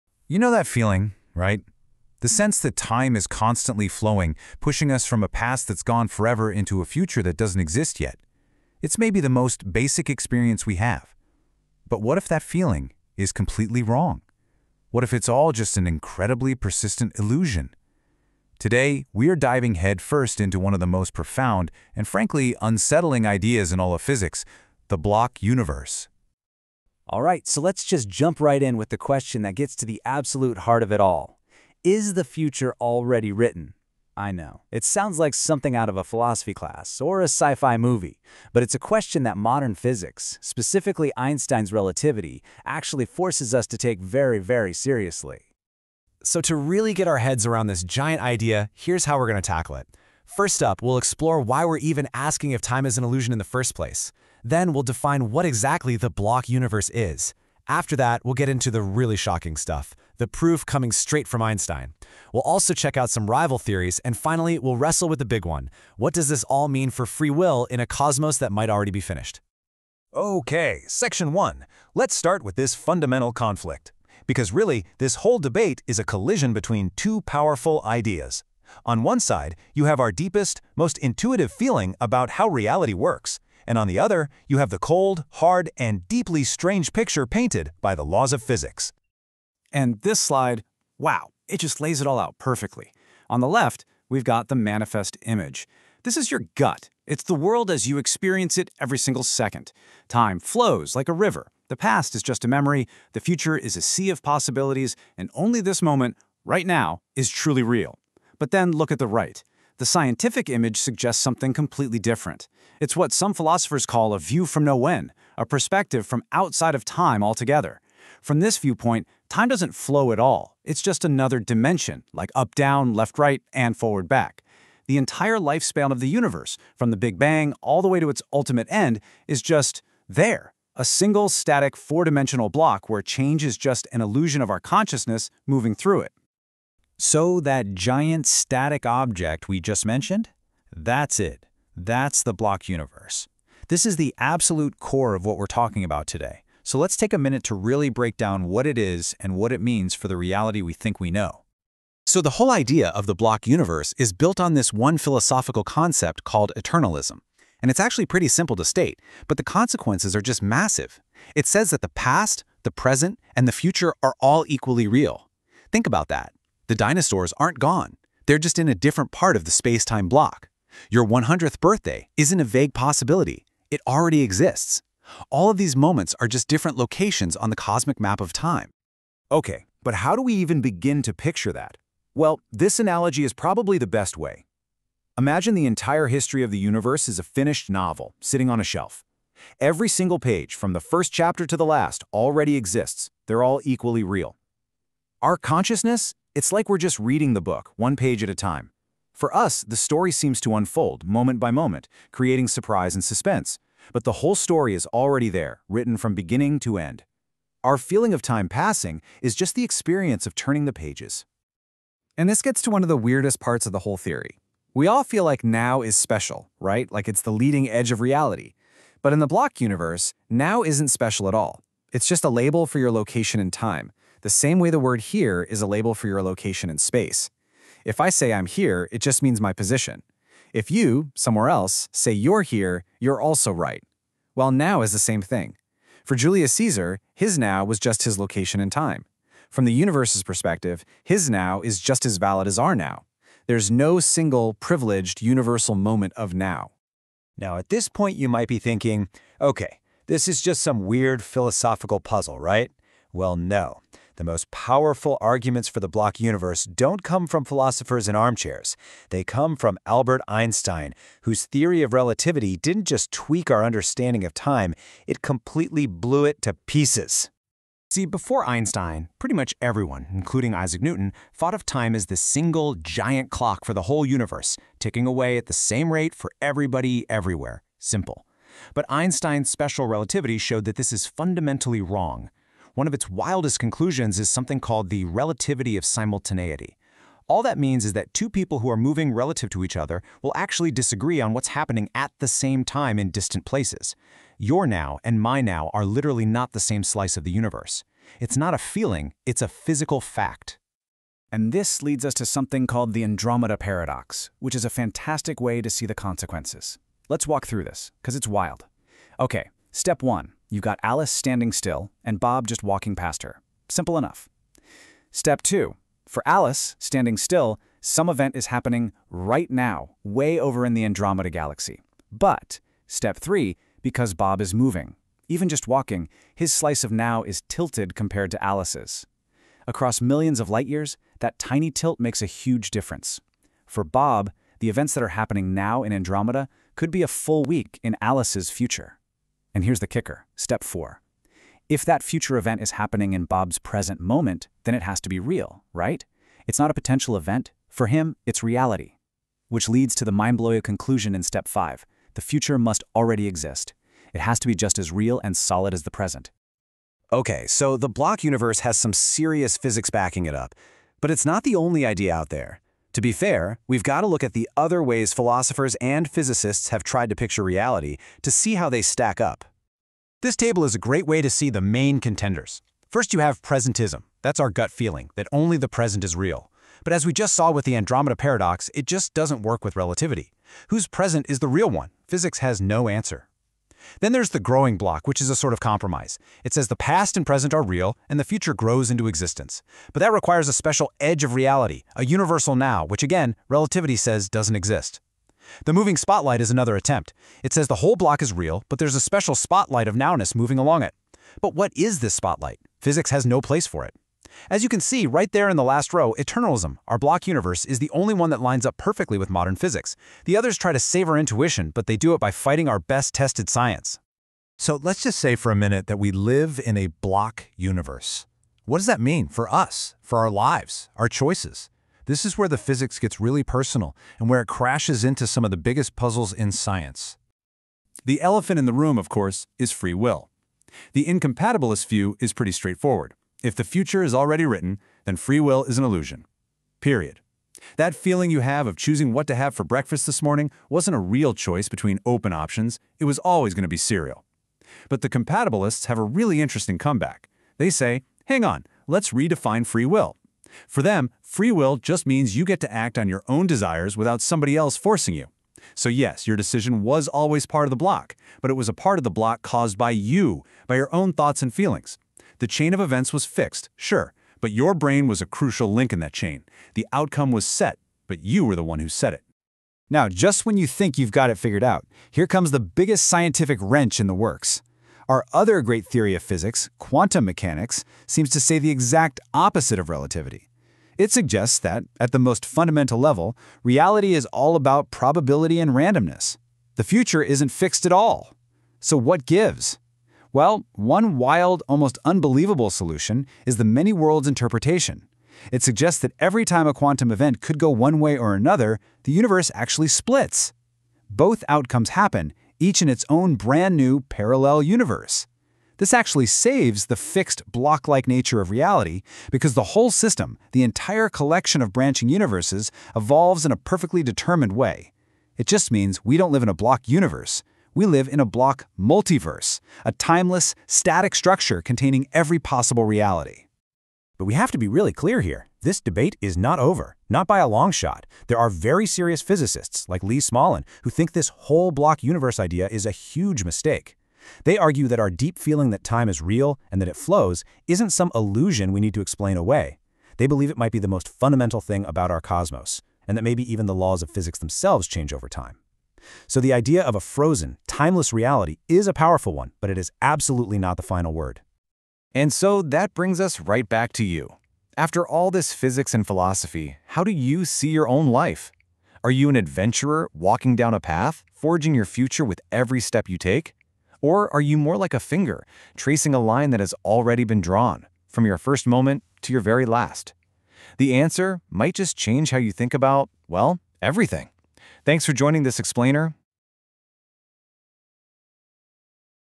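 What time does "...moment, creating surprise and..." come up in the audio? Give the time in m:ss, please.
3:21.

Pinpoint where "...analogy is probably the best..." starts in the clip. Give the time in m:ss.
3:02.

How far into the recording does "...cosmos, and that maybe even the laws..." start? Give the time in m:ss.
9:02.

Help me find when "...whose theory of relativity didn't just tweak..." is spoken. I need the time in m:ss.
4:21.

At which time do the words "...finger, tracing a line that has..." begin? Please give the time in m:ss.
9:24.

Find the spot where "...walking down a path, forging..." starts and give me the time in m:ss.
9:20.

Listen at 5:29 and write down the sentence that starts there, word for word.
Across millions of light years, that tiny tilt makes a huge difference.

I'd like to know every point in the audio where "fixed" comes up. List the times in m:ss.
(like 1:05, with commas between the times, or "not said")
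7:43, 8:07, 8:26.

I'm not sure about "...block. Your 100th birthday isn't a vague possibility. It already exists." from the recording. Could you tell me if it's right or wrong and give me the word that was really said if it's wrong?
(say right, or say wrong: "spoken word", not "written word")
right.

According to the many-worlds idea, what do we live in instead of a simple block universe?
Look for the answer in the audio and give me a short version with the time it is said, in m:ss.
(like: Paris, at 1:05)
a block multiverse, at 8:38.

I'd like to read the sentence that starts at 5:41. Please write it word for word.
If that future event is happening in Bob's present moment, then it has to be real, right?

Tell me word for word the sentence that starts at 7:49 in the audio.
Now, just when you think you've got it figured out, here comes the biggest scientific wrench in the works.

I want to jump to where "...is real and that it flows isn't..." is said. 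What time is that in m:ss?
8:56.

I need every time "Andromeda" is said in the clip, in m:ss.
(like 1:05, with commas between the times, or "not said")
5:03, 5:20, 5:35, 6:17.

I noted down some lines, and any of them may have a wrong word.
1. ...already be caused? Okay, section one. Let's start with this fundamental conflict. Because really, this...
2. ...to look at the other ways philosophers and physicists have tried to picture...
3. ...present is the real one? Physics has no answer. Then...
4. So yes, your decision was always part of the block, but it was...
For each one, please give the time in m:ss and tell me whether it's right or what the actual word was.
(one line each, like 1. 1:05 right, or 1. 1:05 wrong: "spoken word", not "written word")
1. 1:08 wrong: "finished", not "caused"
2. 6:04 right
3. 6:20 right
4. 7:35 right.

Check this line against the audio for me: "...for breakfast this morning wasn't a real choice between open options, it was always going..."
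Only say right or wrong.
right.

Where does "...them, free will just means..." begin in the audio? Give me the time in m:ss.
7:30.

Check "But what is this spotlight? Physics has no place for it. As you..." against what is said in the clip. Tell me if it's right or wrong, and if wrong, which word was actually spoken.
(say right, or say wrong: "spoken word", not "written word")
right.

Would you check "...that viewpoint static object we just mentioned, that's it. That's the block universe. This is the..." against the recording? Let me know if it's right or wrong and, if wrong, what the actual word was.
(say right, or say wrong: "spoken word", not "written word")
wrong: "giant", not "viewpoint".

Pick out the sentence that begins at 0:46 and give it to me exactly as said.
So to really get our heads around this giant idea, here's how we're going to tackle it.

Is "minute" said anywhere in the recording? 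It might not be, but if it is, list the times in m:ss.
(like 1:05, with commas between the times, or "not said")
2:27, 6:55.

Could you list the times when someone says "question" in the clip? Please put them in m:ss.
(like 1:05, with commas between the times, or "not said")
0:28, 0:38.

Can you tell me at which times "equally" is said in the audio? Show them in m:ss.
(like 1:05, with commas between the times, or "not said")
2:44, 3:13.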